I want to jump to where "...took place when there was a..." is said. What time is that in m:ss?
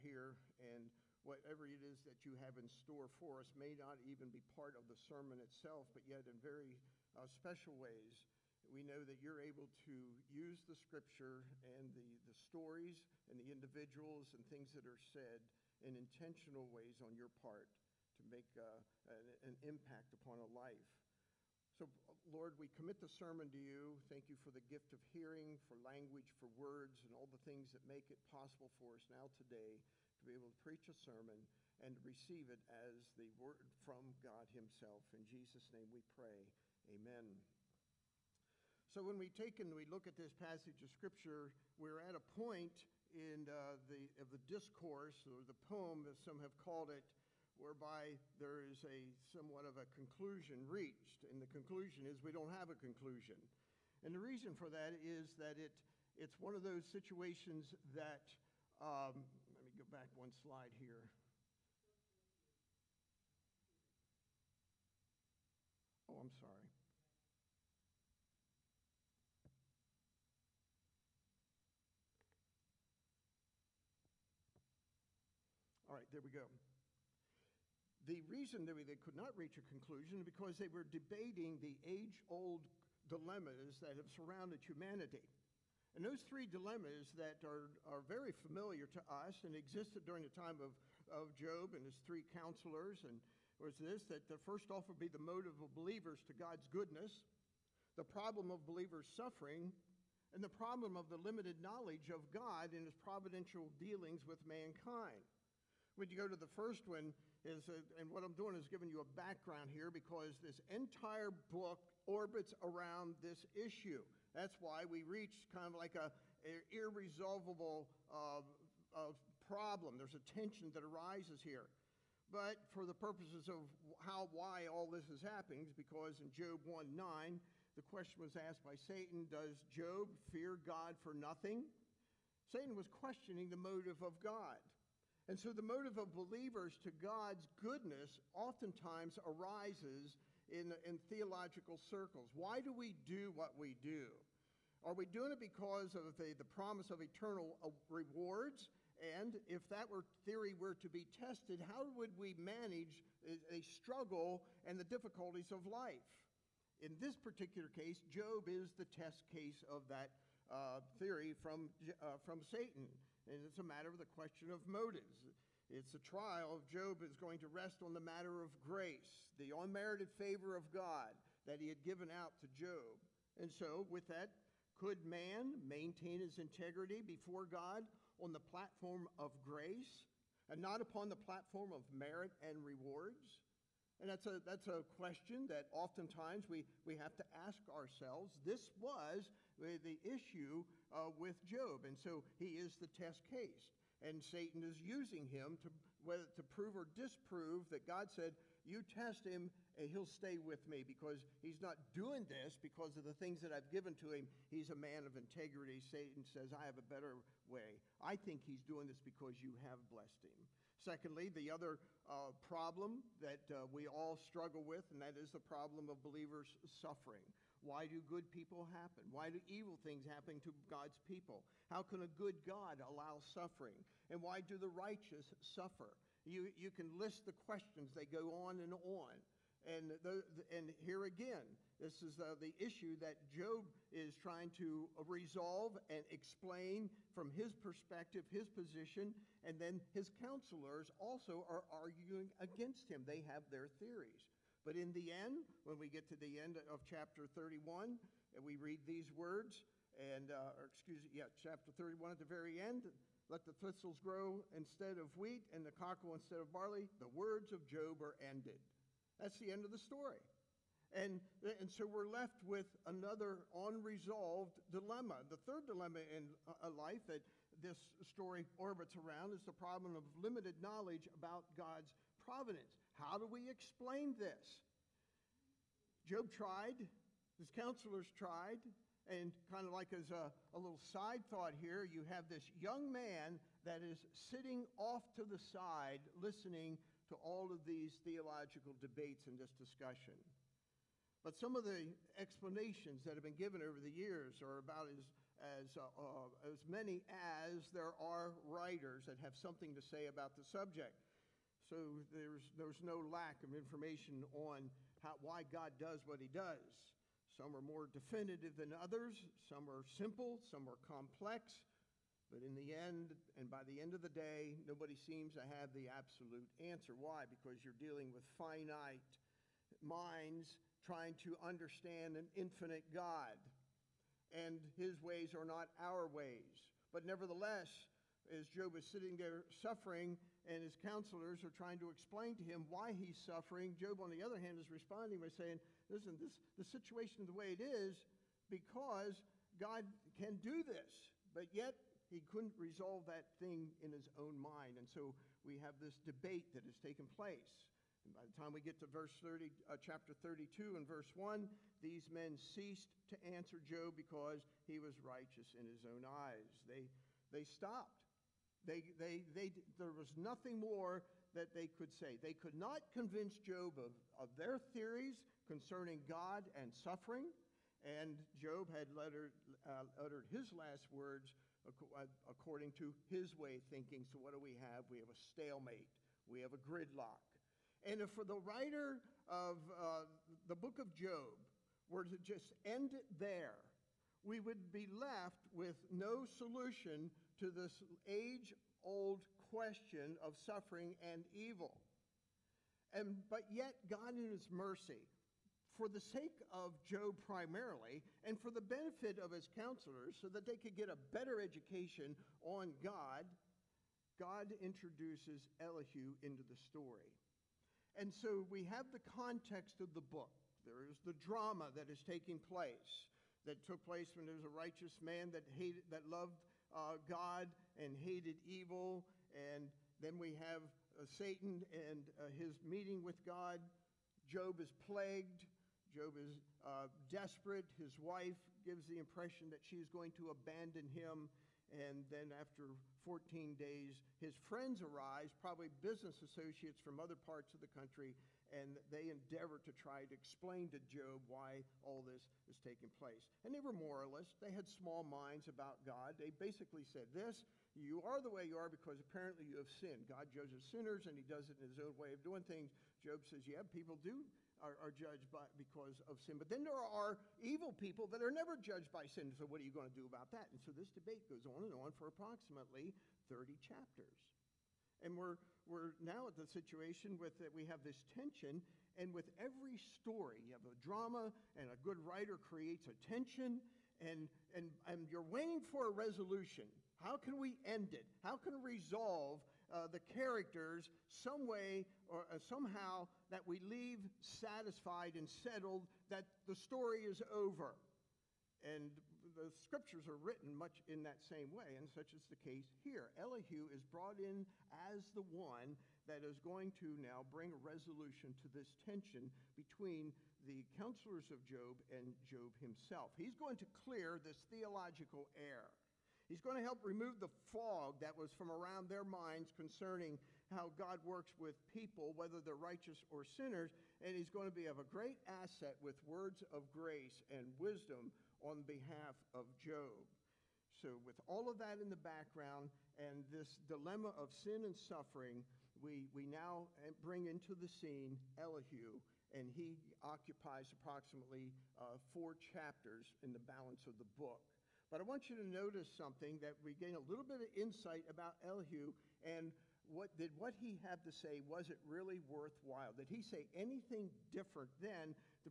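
6:53.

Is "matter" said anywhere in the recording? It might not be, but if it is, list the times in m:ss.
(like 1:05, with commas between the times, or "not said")
2:43, 2:48.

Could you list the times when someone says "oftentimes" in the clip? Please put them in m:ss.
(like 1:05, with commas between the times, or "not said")
2:18, 3:05.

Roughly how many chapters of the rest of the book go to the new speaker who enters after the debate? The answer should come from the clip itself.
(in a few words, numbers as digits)
4.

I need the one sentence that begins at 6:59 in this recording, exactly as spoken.
And then we have uh, Satan and uh, his meeting with God.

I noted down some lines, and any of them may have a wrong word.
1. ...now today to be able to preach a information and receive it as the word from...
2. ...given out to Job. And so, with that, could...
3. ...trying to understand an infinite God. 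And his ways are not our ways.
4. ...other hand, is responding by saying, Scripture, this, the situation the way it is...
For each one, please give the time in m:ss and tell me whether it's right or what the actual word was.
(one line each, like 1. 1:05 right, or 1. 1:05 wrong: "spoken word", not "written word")
1. 0:29 wrong: "sermon", not "information"
2. 2:51 right
3. 5:20 right
4. 5:34 wrong: "Listen", not "Scripture".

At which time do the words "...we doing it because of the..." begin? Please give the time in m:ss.
2:24.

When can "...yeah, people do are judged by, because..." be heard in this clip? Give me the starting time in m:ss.
7:33.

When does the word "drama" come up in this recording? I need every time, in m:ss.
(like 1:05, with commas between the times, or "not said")
6:51, 7:50.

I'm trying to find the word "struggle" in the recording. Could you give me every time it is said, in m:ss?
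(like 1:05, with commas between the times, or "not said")
2:33, 3:34.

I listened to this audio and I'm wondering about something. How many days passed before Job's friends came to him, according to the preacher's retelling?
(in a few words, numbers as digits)
14.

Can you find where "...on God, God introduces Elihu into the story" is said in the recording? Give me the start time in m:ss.
6:42.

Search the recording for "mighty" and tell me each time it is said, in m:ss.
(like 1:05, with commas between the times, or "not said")
not said.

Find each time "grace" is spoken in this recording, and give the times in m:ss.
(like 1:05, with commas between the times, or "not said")
2:48, 2:59, 8:36.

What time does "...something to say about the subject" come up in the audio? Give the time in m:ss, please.
4:59.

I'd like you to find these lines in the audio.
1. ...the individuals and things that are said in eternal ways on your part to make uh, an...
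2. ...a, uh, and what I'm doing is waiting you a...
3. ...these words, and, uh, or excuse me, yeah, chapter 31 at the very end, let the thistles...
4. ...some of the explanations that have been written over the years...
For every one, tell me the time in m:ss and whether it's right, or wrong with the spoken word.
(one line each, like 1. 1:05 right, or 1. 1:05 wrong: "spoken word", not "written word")
1. 0:13 wrong: "intentional", not "eternal"
2. 1:47 wrong: "giving", not "waiting"
3. 4:08 right
4. 4:51 wrong: "given", not "written".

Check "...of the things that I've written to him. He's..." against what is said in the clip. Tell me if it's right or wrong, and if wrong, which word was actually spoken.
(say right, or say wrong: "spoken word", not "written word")
wrong: "given", not "written".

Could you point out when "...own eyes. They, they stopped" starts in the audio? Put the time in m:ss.
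5:55.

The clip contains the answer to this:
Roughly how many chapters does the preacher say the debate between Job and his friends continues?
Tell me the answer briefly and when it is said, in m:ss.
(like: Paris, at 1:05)
30, at 7:43.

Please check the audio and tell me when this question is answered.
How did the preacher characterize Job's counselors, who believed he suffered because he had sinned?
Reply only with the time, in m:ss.
7:23.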